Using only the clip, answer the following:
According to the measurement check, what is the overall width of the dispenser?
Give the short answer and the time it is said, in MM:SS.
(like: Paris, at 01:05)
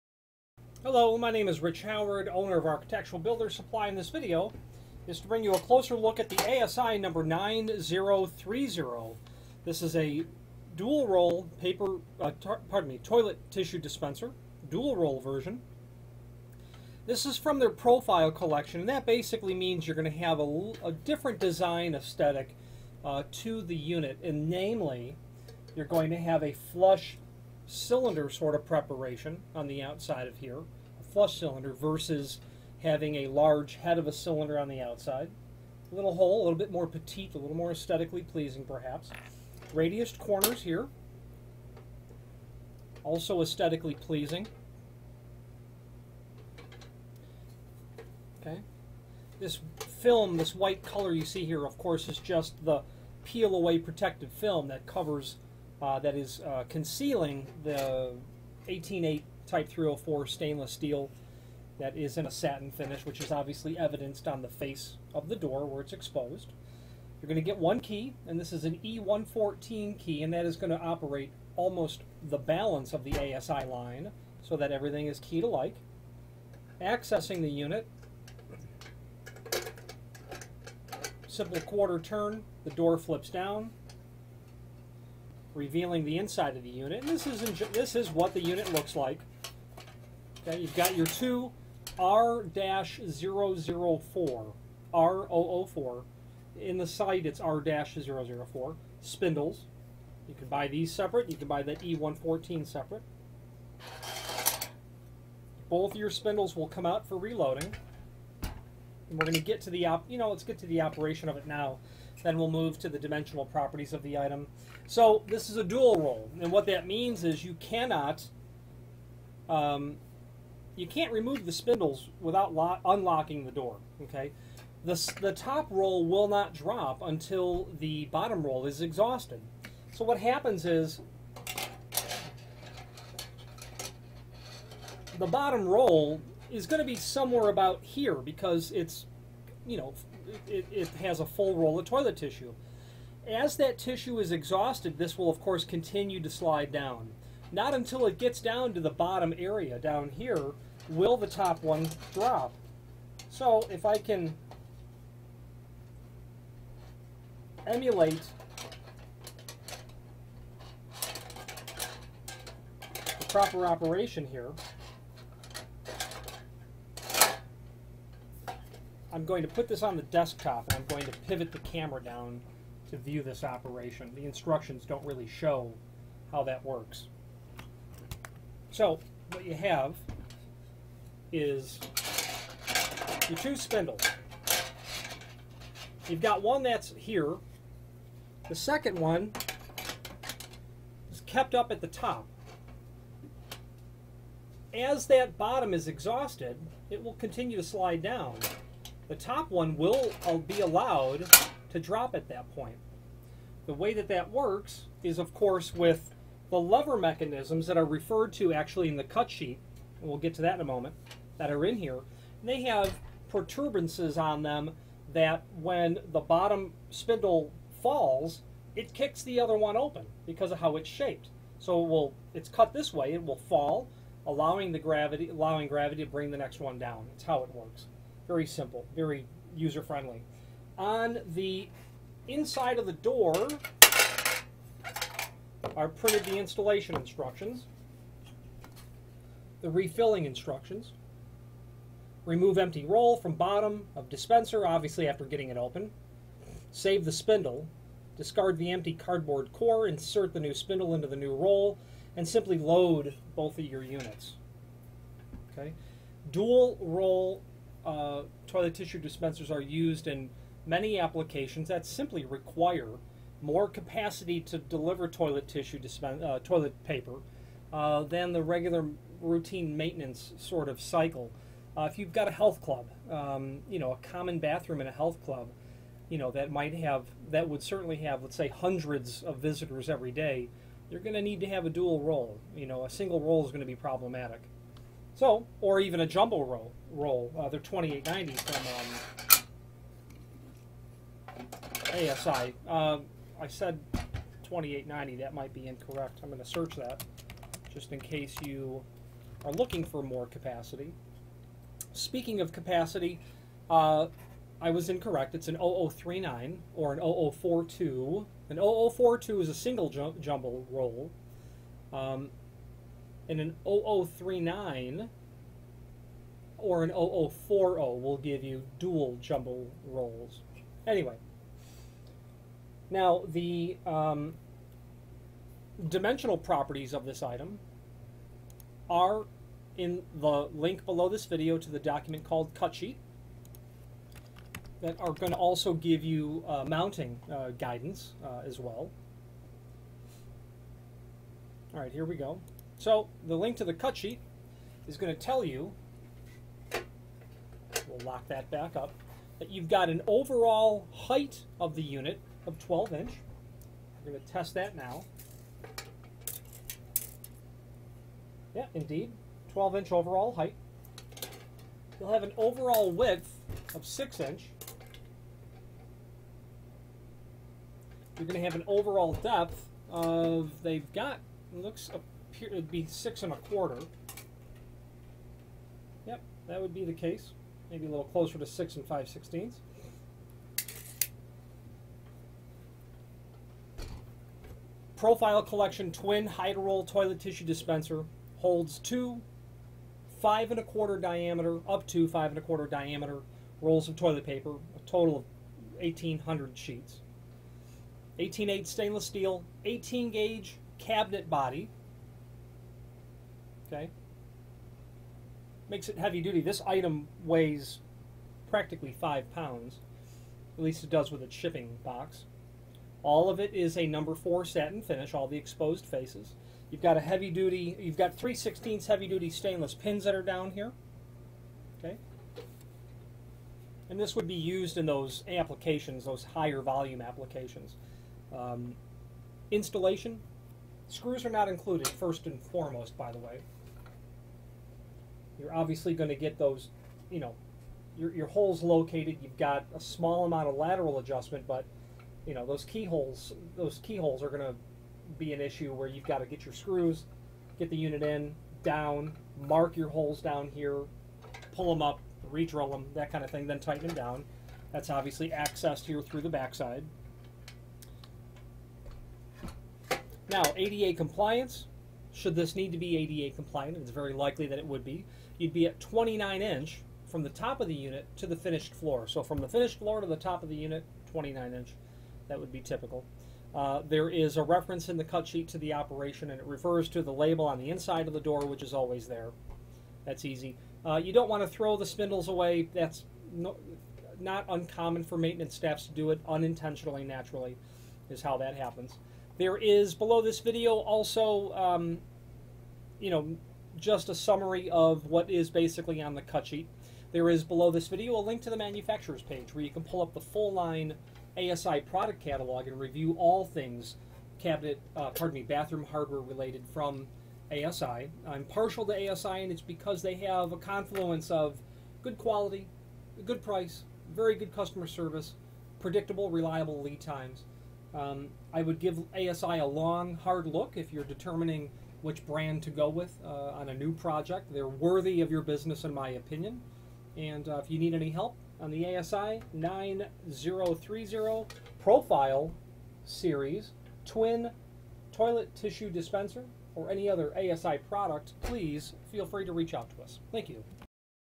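6 inch, at 06:03.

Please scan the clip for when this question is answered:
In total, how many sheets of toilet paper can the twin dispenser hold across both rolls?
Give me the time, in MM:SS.
06:35.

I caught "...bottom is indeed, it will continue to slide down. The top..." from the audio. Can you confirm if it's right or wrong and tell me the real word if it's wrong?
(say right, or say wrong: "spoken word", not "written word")
wrong: "exhausted", not "indeed".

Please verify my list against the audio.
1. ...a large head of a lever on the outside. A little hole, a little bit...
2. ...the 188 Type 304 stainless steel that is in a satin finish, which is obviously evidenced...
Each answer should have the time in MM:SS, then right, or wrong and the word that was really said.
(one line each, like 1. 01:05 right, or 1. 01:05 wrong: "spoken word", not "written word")
1. 00:33 wrong: "cylinder", not "lever"
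2. 00:57 right.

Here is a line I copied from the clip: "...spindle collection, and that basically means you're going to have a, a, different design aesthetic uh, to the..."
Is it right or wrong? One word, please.
wrong.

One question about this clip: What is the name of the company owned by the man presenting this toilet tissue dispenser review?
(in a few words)
Architectural Builder Supply.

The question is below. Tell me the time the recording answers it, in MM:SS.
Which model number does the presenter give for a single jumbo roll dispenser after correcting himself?
05:08.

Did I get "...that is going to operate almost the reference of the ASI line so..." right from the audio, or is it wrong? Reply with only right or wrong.
wrong.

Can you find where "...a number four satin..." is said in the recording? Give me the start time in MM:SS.
06:53.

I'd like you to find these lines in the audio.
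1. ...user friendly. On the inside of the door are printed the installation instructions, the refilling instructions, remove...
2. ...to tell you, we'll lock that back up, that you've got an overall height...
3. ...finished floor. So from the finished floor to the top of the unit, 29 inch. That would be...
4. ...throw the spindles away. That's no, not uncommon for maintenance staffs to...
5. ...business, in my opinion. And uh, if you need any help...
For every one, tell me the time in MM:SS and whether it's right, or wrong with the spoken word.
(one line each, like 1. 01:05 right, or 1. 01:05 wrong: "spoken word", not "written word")
1. 03:49 right
2. 05:45 right
3. 07:48 right
4. 08:01 right
5. 08:45 right.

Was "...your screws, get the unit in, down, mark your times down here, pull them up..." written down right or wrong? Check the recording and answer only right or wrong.
wrong.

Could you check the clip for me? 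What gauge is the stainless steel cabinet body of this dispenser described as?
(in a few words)
18 gauge.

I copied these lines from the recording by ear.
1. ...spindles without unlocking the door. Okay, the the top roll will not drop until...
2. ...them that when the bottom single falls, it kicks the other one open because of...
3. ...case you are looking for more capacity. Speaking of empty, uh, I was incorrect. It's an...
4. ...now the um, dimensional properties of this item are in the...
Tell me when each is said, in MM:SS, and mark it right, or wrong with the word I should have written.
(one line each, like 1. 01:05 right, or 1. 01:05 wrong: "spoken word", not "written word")
1. 02:01 right
2. 03:34 wrong: "spindle", not "single"
3. 04:58 wrong: "capacity", not "empty"
4. 05:22 right.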